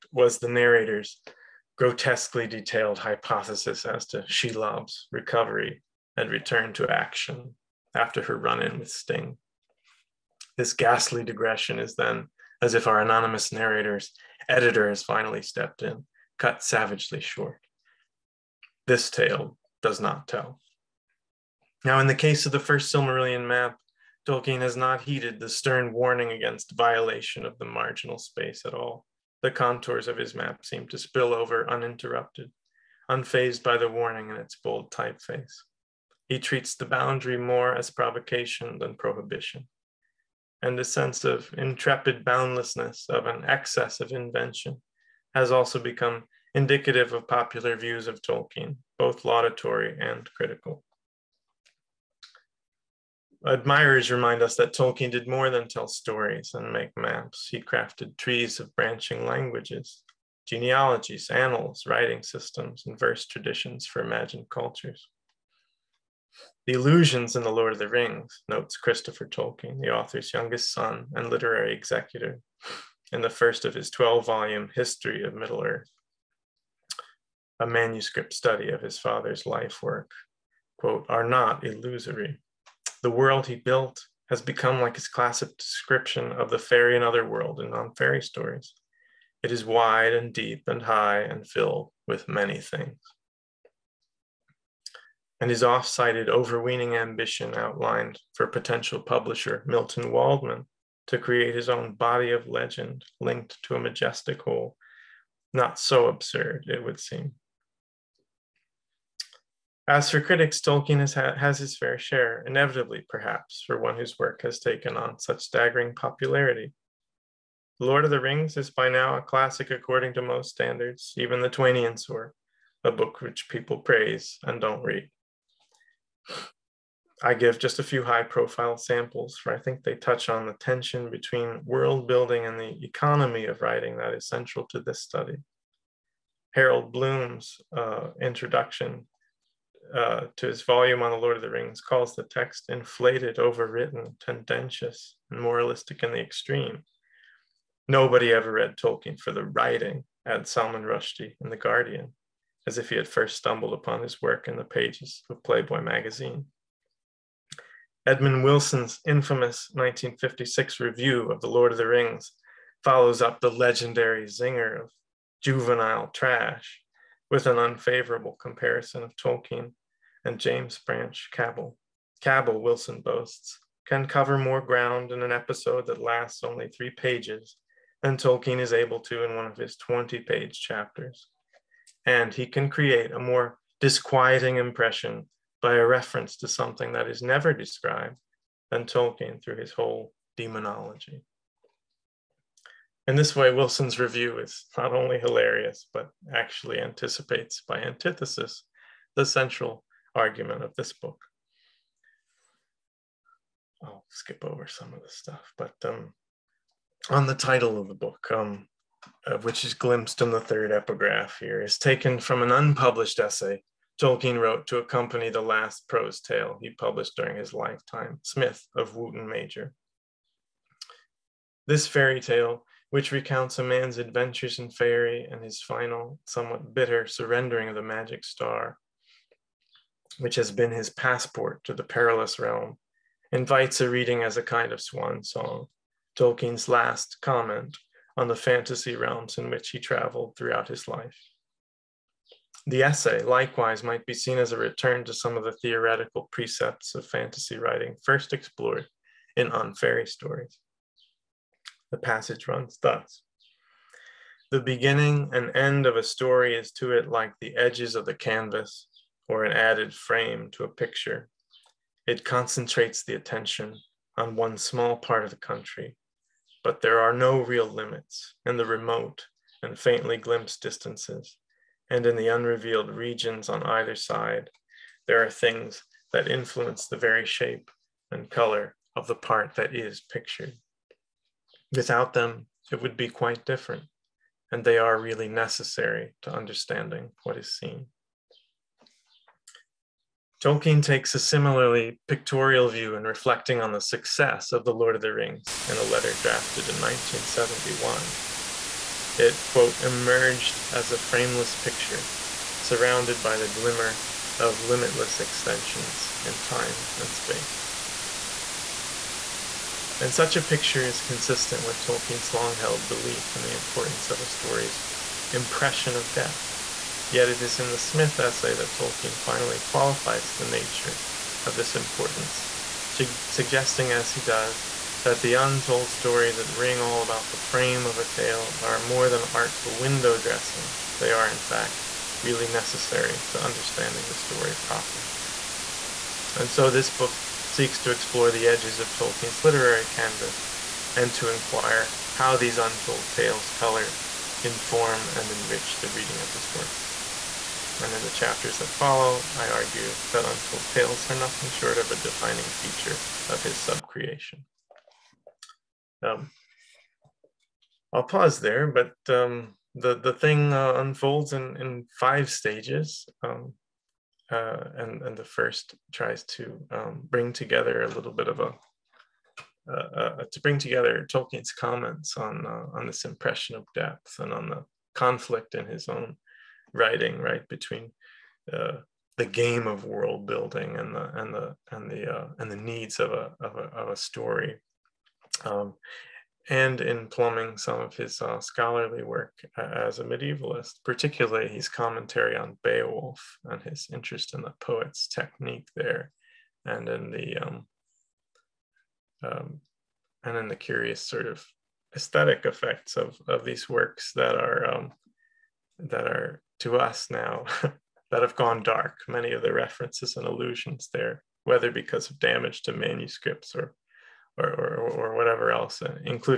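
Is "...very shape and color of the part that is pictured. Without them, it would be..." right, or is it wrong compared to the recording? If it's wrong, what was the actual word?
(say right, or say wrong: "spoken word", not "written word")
right.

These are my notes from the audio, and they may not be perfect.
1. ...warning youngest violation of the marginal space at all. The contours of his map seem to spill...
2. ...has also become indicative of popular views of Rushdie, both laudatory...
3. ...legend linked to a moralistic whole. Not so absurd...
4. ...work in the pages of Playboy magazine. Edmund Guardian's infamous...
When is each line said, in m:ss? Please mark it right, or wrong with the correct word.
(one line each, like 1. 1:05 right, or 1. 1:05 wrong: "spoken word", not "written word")
1. 0:25 wrong: "against", not "youngest"
2. 0:45 wrong: "Tolkien", not "Rushdie"
3. 1:42 wrong: "majestic", not "moralistic"
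4. 2:34 wrong: "Wilson", not "Guardian".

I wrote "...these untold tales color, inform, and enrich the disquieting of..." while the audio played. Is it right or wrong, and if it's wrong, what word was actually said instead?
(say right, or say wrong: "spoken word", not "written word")
wrong: "reading", not "disquieting".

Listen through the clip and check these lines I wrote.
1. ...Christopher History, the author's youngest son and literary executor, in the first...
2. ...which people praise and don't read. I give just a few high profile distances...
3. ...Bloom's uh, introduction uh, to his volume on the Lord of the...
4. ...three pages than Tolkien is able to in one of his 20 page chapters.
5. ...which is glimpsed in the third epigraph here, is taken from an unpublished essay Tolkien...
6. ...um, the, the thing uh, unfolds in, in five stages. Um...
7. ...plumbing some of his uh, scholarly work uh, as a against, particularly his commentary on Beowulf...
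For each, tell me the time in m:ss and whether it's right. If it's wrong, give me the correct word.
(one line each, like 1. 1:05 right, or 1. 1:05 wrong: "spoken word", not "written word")
1. 1:08 wrong: "Tolkien", not "History"
2. 2:03 wrong: "samples", not "distances"
3. 2:16 right
4. 2:56 right
5. 3:29 right
6. 5:59 right
7. 6:27 wrong: "medievalist", not "against".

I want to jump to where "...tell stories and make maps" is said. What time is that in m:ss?
0:55.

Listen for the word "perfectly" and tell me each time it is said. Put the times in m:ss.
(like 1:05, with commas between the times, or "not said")
not said.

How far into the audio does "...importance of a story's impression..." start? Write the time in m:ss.
5:13.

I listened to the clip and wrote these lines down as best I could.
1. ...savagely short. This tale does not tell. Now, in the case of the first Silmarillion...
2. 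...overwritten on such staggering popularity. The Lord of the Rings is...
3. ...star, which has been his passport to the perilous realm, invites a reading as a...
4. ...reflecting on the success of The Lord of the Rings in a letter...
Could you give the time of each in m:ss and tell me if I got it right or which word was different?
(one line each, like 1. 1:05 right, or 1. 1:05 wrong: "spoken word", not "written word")
1. 0:16 right
2. 1:54 wrong: "taken", not "overwritten"
3. 3:48 right
4. 4:53 right.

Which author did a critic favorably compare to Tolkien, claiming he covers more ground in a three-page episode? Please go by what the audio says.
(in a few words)
James Branch Cabell.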